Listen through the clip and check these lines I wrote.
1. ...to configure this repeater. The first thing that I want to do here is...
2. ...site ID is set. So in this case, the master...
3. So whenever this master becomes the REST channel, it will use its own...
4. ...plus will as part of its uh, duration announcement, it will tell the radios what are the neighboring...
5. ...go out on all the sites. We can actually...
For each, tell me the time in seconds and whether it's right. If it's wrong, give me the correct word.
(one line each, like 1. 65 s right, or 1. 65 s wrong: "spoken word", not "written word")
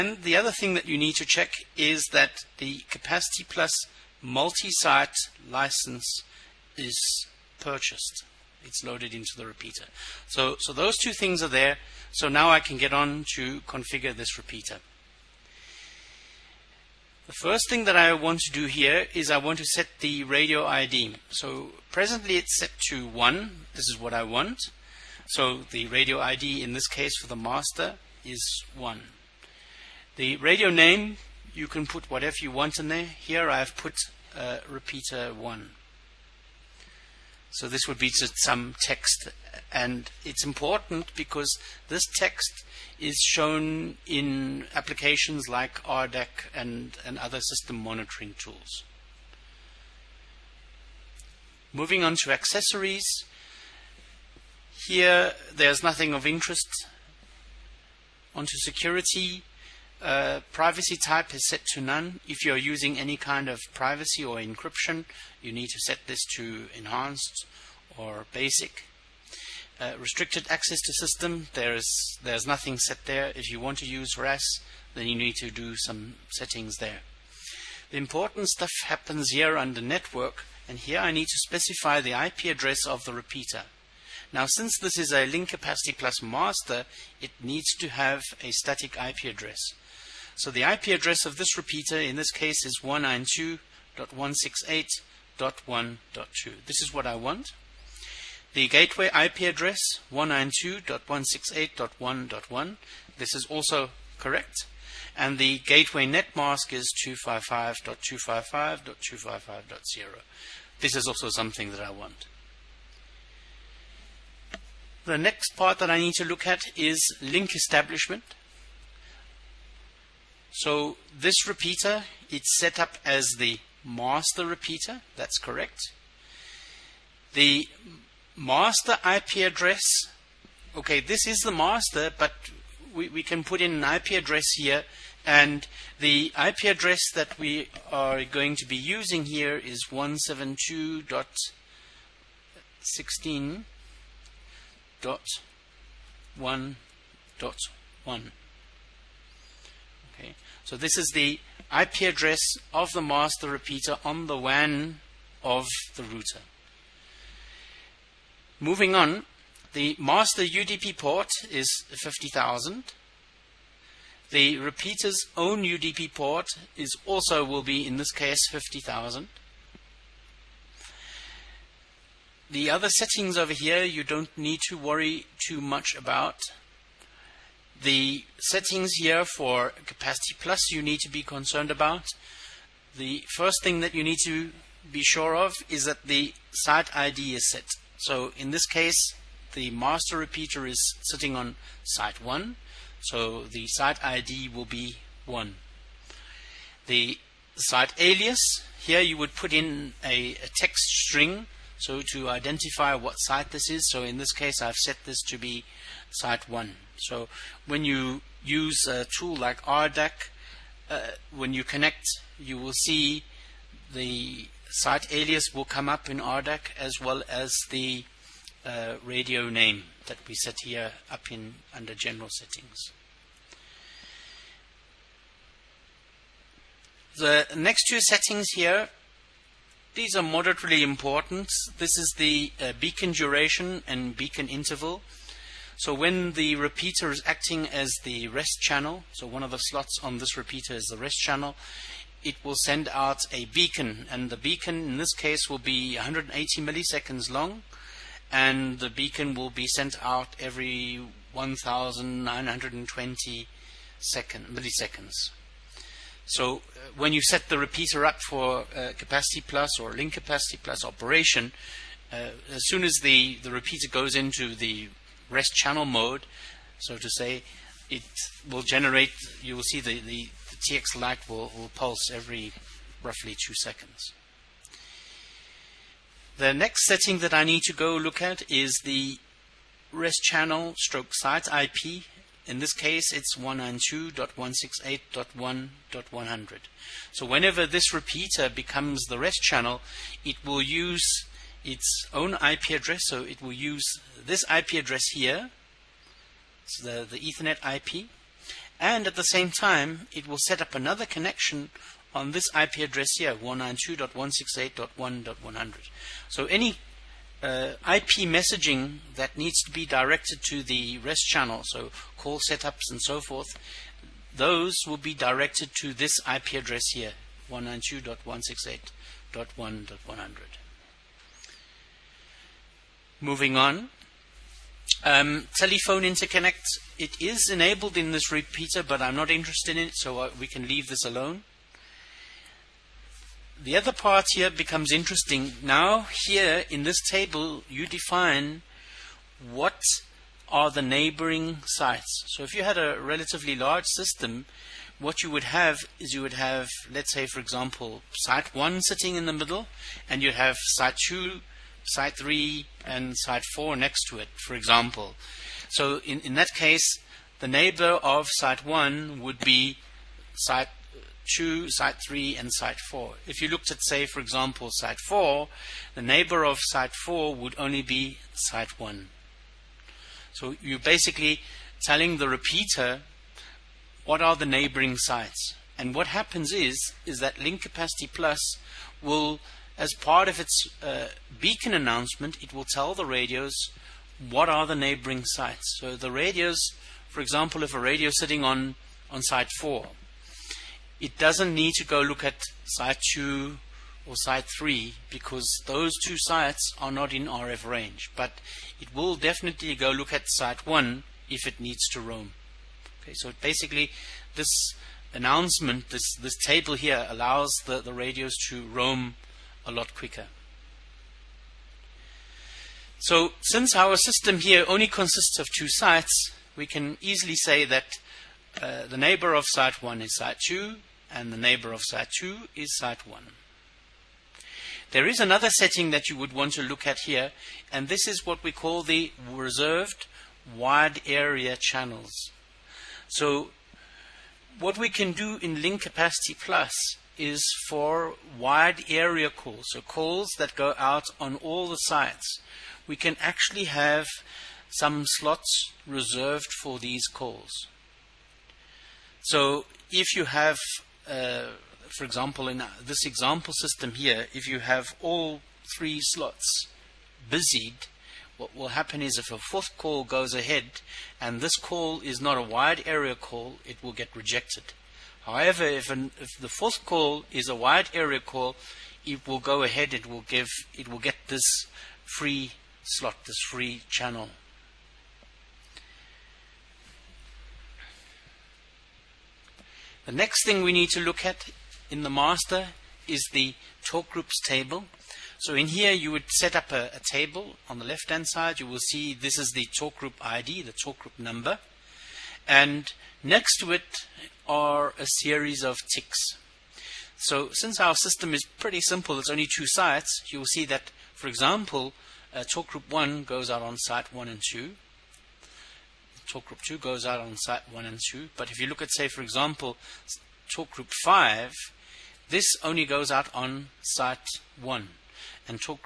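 1. 13 s right
2. 186 s right
3. 287 s wrong: "repeater", not "master"
4. 378 s wrong: "beacon", not "duration"
5. 440 s right.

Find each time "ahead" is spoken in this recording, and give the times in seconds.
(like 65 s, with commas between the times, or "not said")
460 s, 469 s.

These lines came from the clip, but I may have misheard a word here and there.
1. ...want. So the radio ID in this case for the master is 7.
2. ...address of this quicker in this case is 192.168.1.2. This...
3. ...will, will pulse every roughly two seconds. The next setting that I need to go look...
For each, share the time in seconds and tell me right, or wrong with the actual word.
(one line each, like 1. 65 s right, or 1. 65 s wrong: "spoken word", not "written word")
1. 24 s wrong: "1", not "7"
2. 90 s wrong: "repeater", not "quicker"
3. 271 s right.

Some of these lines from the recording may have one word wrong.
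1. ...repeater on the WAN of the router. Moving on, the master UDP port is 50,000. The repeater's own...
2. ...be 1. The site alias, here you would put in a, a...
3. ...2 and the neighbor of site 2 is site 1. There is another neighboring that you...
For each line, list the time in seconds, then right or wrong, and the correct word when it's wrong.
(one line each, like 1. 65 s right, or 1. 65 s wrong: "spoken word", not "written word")
1. 153 s right
2. 194 s right
3. 420 s wrong: "setting", not "neighboring".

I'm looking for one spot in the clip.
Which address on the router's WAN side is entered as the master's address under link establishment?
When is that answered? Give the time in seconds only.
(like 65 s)
139 s.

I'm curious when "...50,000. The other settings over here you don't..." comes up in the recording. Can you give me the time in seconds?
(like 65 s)
168 s.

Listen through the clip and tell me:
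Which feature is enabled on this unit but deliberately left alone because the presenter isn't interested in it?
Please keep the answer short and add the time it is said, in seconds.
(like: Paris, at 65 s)
Telephone interconnect, at 325 s.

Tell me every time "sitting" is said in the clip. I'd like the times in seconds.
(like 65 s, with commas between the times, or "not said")
191 s, 348 s, 388 s.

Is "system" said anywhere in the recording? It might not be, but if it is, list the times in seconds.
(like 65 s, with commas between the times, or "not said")
47 s, 70 s, 343 s, 413 s, 453 s, 497 s.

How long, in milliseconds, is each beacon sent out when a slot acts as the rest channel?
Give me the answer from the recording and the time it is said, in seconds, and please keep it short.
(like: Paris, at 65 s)
180 milliseconds, at 245 s.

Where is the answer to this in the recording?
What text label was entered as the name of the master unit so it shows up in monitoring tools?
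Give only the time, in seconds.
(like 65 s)
34 s.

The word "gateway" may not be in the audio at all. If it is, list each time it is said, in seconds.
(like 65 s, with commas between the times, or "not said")
98 s, 105 s.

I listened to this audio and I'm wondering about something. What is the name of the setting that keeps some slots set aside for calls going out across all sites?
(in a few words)
Reserved wide area channels.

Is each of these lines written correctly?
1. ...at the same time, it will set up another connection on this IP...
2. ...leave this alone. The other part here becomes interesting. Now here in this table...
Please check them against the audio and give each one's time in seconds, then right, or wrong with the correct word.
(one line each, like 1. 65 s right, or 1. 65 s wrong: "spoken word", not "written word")
1. 299 s right
2. 330 s right.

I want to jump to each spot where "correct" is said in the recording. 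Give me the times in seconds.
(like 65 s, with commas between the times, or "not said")
104 s, 125 s.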